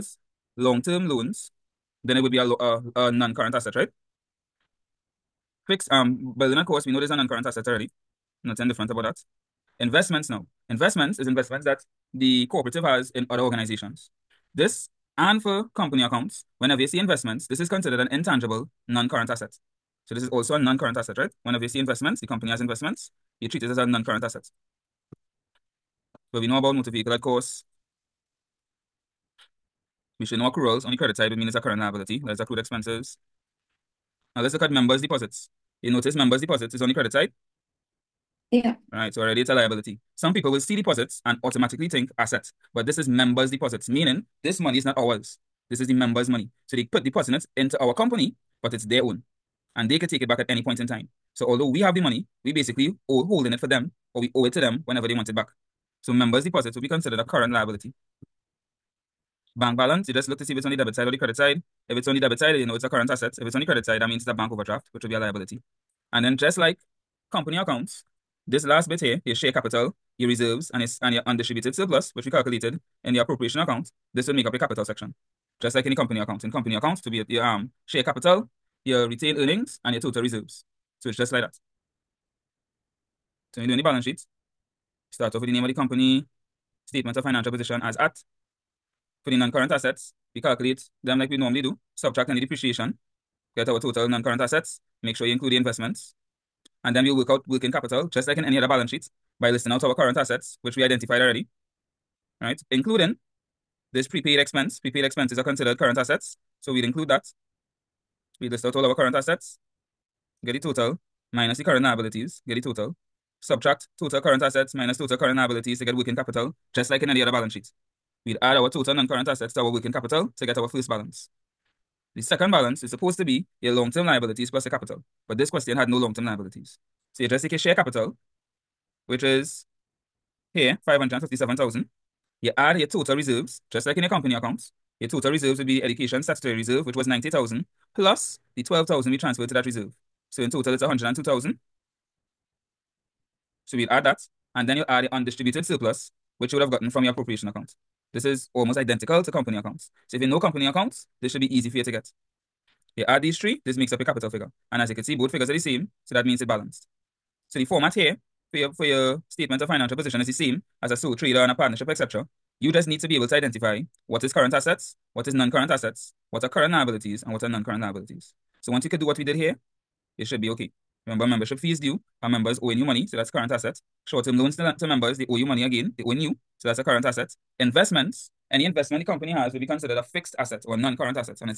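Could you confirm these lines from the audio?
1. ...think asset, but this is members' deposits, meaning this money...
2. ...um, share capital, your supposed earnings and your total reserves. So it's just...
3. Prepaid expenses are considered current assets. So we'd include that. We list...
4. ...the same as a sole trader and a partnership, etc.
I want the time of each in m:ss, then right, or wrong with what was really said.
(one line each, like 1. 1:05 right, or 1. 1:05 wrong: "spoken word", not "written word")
1. 0:41 right
2. 1:17 wrong: "retained", not "supposed"
3. 1:44 right
4. 2:40 right.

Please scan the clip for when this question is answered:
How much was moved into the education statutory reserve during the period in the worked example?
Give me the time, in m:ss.
2:18.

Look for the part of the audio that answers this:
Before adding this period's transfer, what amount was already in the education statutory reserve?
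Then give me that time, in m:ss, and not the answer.
2:17.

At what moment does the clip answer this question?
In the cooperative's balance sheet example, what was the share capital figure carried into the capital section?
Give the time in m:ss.
2:10.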